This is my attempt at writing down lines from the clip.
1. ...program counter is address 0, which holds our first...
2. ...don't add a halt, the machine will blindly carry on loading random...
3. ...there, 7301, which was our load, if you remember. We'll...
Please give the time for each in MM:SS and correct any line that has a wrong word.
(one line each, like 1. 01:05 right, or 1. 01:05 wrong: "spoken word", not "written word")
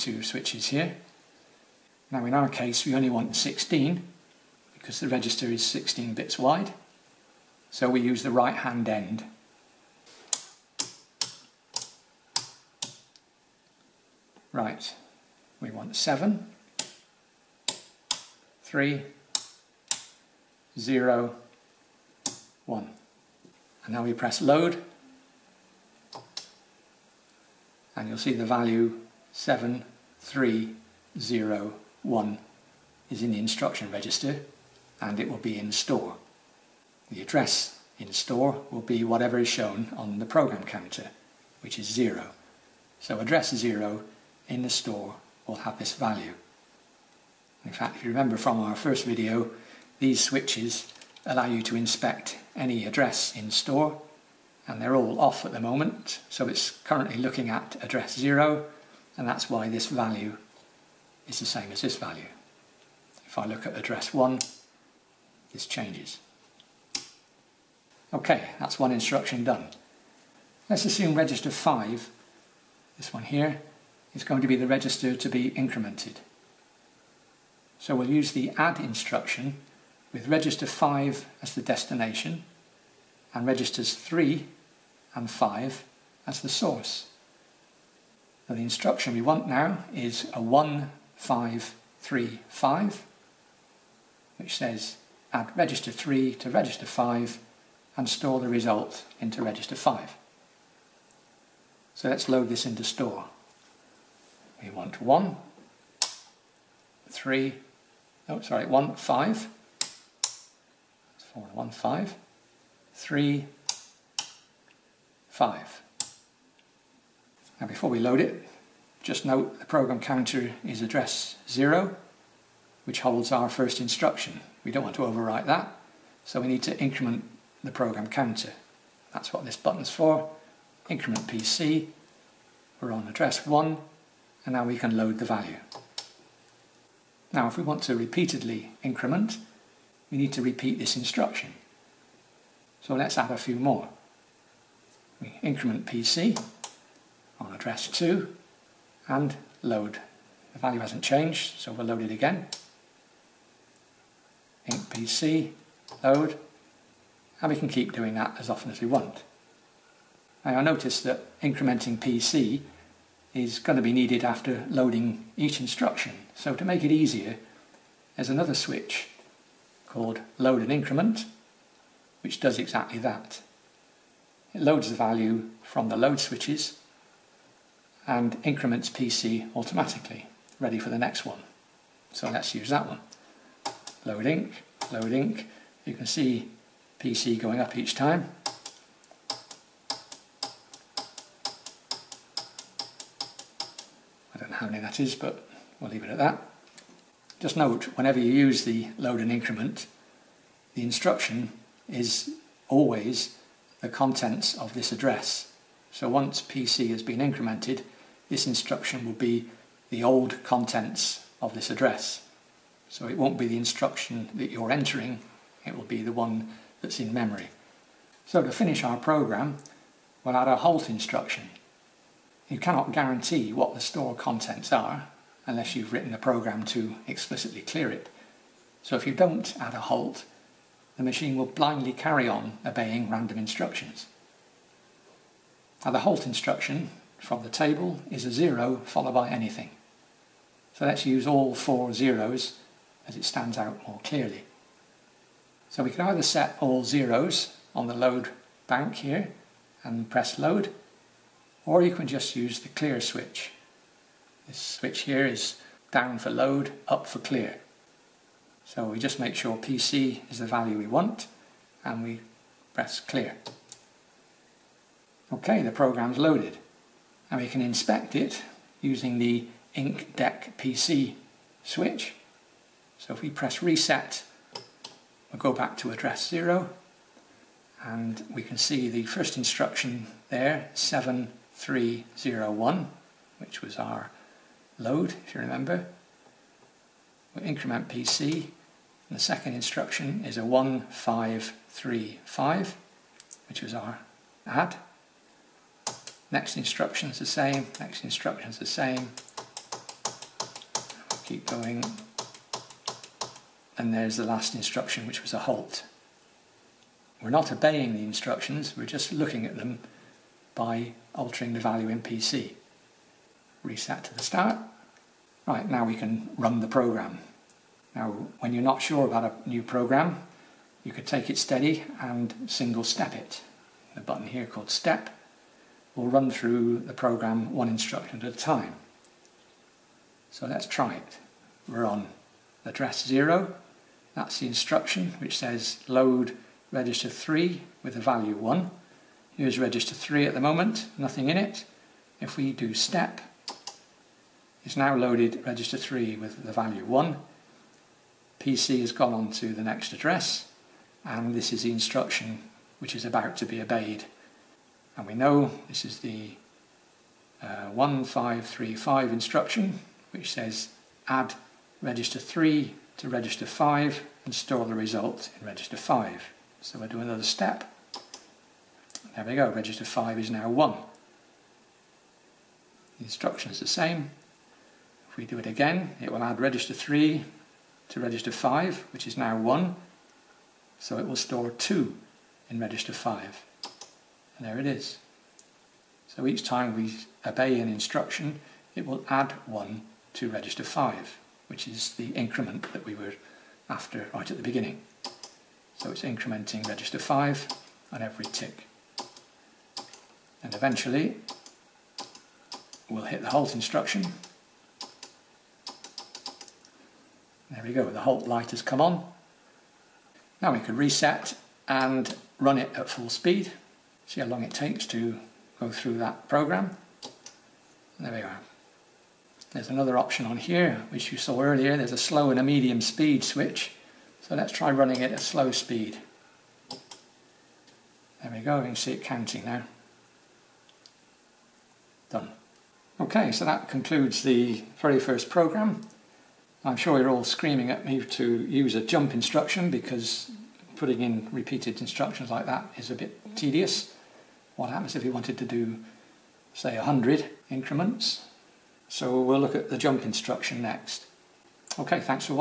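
1. 01:59 right
2. 03:49 wrong: "obeying", not "loading"
3. 04:40 right.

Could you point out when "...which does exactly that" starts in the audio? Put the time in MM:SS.
02:52.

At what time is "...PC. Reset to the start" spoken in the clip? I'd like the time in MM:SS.
05:12.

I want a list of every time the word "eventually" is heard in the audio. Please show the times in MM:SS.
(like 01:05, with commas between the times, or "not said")
06:40.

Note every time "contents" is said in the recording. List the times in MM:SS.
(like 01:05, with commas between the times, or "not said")
03:23, 03:30, 03:44.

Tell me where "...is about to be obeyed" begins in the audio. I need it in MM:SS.
05:52.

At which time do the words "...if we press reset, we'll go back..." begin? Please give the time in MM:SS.
04:33.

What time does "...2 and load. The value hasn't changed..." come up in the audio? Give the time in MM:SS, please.
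02:27.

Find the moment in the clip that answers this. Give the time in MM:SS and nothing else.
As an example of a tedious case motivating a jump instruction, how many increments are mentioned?
07:26.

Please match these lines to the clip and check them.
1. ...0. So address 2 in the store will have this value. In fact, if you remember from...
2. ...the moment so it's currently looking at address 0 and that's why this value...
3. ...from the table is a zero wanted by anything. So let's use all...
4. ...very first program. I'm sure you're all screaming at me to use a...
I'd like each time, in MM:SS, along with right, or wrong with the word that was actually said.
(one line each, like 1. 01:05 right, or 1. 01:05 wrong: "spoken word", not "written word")
1. 00:41 wrong: "0", not "2"
2. 00:55 right
3. 03:57 wrong: "followed", not "wanted"
4. 07:14 right.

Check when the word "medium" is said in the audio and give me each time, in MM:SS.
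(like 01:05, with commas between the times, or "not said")
07:02.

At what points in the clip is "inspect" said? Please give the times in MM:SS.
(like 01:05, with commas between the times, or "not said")
00:51, 04:27.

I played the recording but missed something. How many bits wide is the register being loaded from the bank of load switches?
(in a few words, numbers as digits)
16.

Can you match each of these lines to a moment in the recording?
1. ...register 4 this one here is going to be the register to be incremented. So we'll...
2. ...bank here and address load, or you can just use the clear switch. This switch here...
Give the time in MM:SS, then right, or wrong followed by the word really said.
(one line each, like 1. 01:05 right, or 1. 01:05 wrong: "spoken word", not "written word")
1. 01:11 wrong: "5", not "4"
2. 04:08 wrong: "press", not "address".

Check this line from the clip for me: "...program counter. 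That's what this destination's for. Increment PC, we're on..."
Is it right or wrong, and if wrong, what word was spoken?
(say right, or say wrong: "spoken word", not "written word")
wrong: "button", not "destination".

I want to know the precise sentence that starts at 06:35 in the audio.
So it's incrementing register 5 on every tick.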